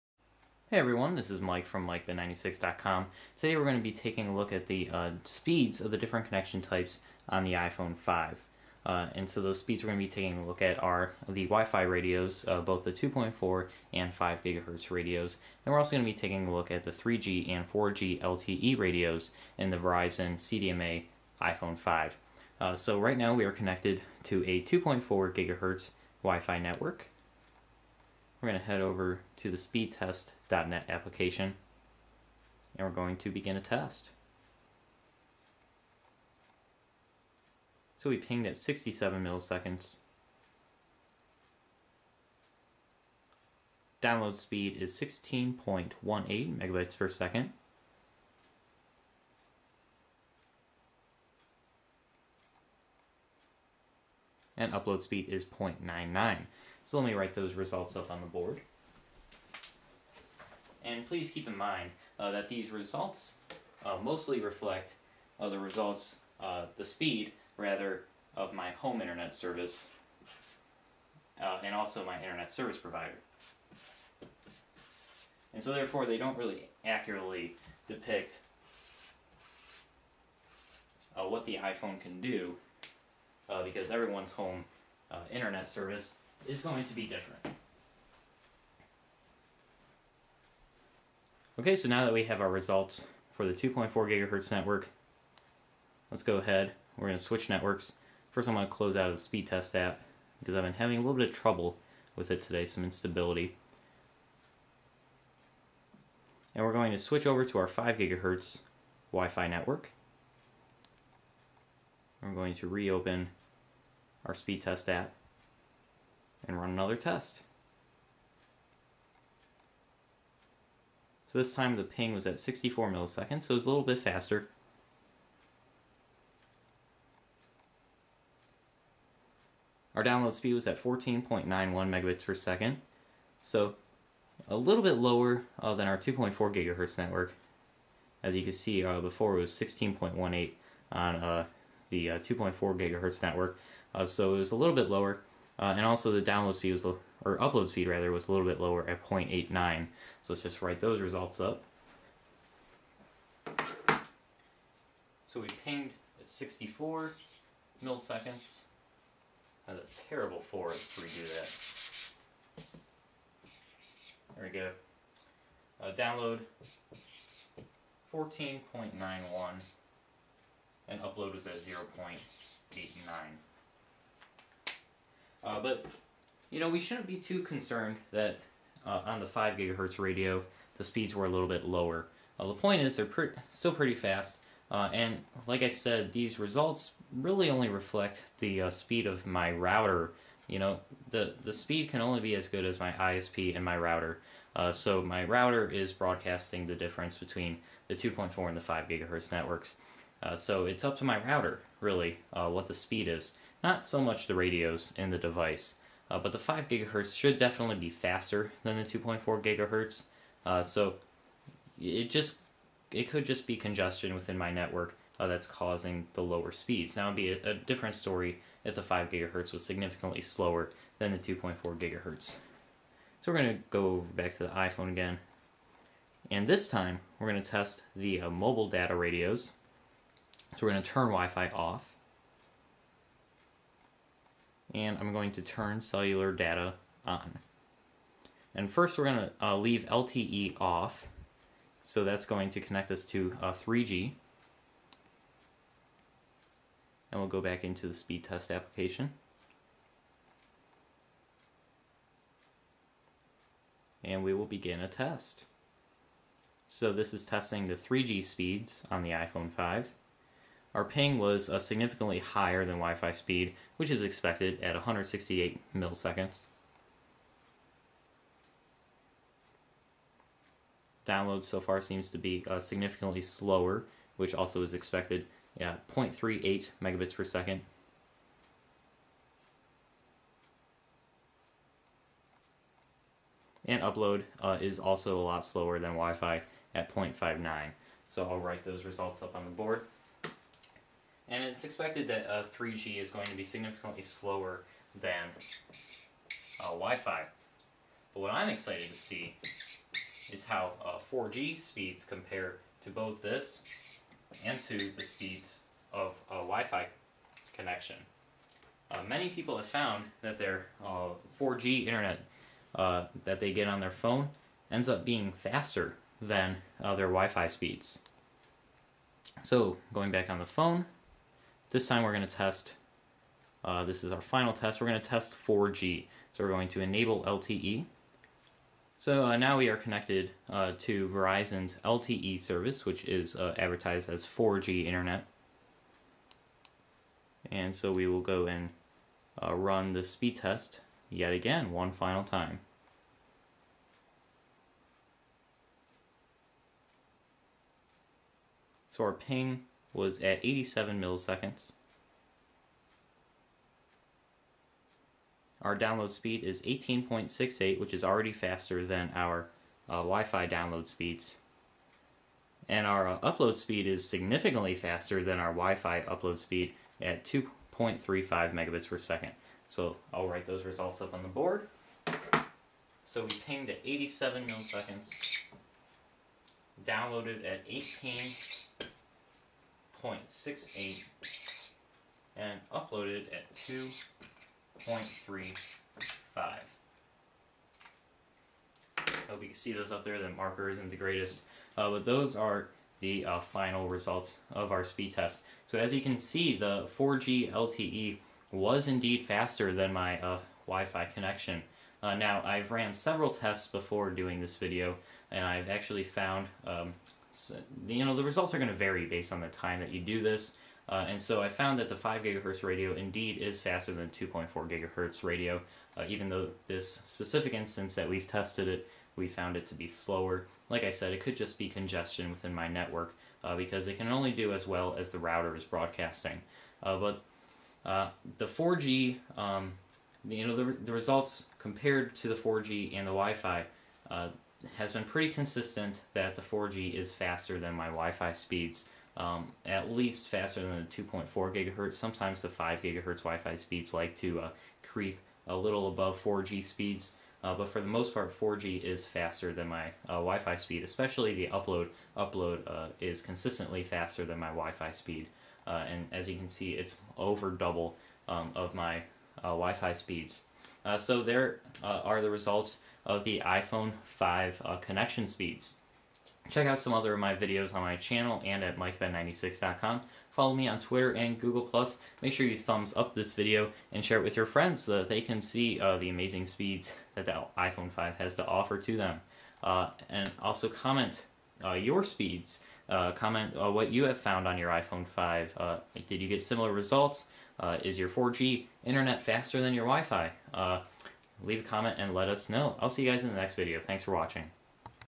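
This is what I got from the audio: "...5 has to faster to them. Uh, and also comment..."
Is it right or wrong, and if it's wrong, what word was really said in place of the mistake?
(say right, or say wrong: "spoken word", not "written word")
wrong: "offer", not "faster".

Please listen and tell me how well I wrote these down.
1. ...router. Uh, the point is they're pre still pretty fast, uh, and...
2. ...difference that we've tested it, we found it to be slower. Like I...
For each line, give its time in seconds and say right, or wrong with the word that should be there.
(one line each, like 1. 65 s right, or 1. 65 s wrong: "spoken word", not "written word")
1. 181 s wrong: "lower", not "router"
2. 417 s wrong: "instance", not "difference".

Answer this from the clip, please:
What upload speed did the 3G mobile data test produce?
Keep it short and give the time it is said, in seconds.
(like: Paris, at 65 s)
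0.59, at 286 s.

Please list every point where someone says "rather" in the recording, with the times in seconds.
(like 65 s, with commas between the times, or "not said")
67 s, 147 s.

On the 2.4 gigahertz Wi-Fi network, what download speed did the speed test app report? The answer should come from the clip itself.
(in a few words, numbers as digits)
16.18.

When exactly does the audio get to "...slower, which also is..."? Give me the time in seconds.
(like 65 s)
273 s.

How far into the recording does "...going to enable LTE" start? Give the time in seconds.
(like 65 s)
326 s.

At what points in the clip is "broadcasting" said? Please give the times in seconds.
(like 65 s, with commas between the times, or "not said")
195 s, 425 s.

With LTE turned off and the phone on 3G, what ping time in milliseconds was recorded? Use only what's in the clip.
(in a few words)
168.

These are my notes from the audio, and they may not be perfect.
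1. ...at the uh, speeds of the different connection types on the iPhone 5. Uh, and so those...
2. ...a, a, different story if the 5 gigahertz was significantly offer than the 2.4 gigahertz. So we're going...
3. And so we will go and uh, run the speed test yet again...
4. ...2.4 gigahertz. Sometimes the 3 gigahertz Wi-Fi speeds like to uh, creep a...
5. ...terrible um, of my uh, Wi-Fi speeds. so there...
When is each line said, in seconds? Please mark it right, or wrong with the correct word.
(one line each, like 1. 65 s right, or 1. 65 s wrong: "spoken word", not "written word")
1. 4 s right
2. 217 s wrong: "slower", not "offer"
3. 337 s right
4. 441 s wrong: "5", not "3"
5. 457 s wrong: "double", not "terrible".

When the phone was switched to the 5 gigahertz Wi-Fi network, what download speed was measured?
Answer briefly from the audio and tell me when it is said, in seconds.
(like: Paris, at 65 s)
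14.91, at 129 s.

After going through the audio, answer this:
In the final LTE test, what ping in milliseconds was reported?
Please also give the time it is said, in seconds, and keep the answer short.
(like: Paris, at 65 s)
87, at 349 s.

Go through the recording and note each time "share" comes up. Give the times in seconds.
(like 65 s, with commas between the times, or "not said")
474 s.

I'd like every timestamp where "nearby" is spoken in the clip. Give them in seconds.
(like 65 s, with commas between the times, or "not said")
not said.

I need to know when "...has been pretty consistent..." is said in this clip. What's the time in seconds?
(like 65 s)
434 s.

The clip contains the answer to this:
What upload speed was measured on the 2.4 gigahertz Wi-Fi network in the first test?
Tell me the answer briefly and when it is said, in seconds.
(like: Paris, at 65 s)
0.99, at 55 s.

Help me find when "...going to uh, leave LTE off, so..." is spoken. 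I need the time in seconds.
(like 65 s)
239 s.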